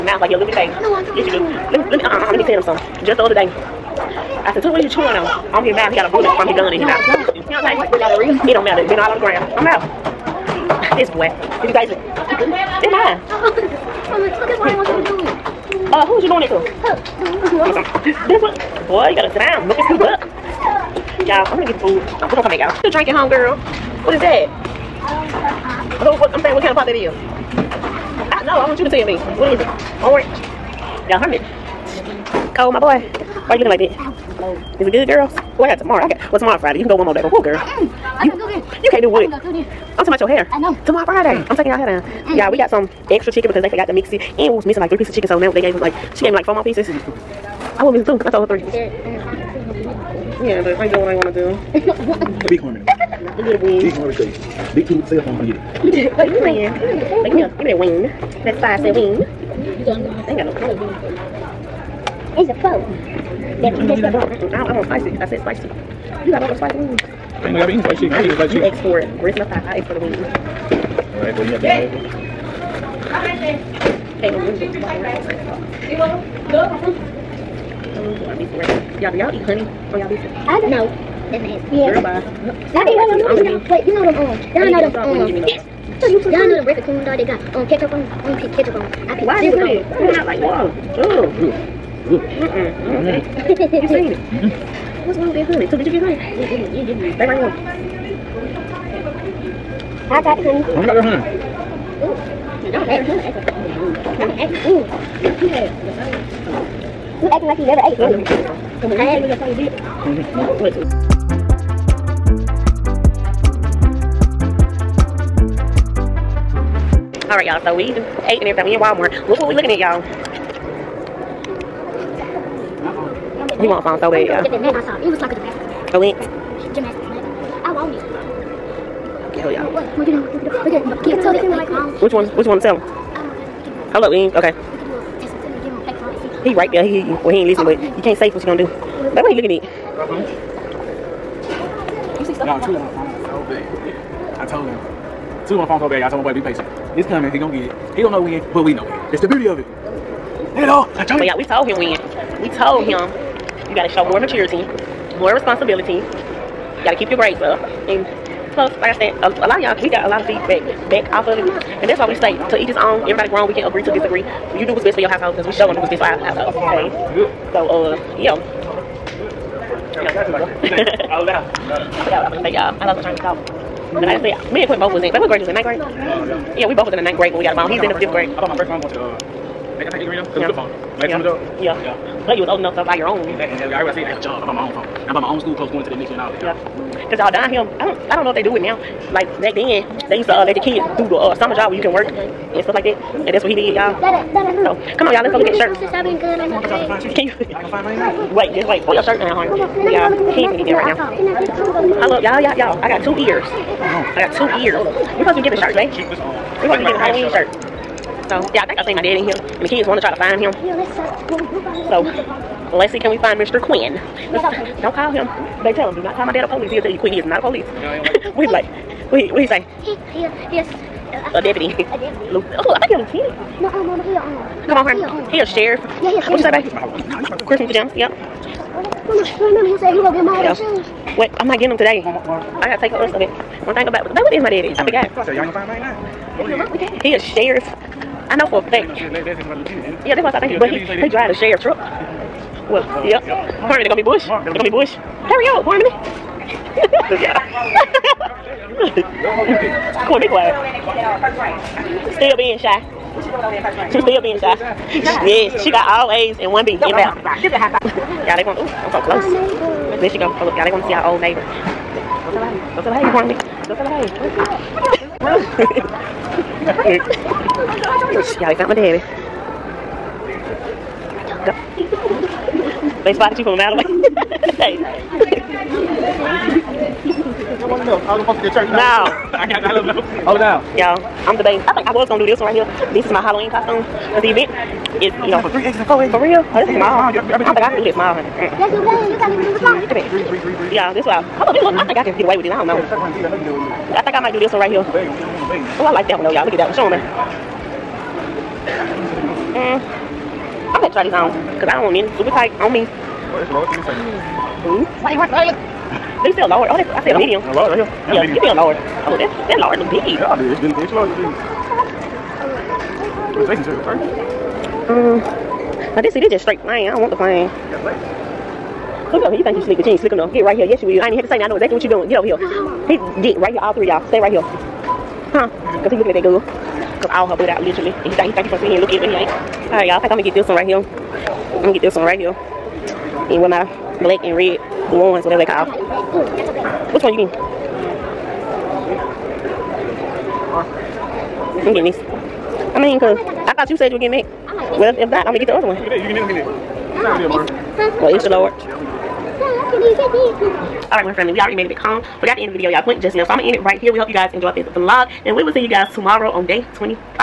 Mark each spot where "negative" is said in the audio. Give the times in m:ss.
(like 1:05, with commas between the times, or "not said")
not said.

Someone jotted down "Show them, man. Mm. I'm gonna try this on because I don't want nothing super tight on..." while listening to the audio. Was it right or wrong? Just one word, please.
right.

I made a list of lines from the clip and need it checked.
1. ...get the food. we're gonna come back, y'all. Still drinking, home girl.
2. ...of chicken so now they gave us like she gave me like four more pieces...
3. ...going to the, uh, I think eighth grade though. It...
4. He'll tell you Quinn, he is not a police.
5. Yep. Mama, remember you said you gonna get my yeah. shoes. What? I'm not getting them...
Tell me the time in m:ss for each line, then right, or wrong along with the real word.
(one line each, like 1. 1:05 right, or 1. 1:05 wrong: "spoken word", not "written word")
1. 0:21 right
2. 0:45 right
3. 2:58 right
4. 3:36 right
5. 3:47 right.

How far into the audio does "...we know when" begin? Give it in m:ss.
2:28.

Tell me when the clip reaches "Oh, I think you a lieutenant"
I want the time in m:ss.
3:42.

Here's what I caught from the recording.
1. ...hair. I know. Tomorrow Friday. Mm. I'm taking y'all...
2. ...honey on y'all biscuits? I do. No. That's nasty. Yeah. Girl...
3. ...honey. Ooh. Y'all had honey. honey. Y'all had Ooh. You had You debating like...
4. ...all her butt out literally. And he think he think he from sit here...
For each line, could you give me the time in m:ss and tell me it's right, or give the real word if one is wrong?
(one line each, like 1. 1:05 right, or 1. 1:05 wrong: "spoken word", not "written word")
1. 0:40 right
2. 1:19 right
3. 1:41 wrong: "acting", not "debating"
4. 5:27 right.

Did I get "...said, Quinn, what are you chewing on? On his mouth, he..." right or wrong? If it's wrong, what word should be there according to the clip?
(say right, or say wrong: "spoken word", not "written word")
wrong: "Tuda", not "Quinn".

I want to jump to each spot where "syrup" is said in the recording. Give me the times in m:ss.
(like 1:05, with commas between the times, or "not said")
1:29.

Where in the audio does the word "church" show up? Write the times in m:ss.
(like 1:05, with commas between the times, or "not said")
4:38.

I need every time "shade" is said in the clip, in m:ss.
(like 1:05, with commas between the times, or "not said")
0:54.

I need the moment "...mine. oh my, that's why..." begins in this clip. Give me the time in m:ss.
0:12.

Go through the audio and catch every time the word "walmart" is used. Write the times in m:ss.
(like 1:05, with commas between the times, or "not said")
1:58.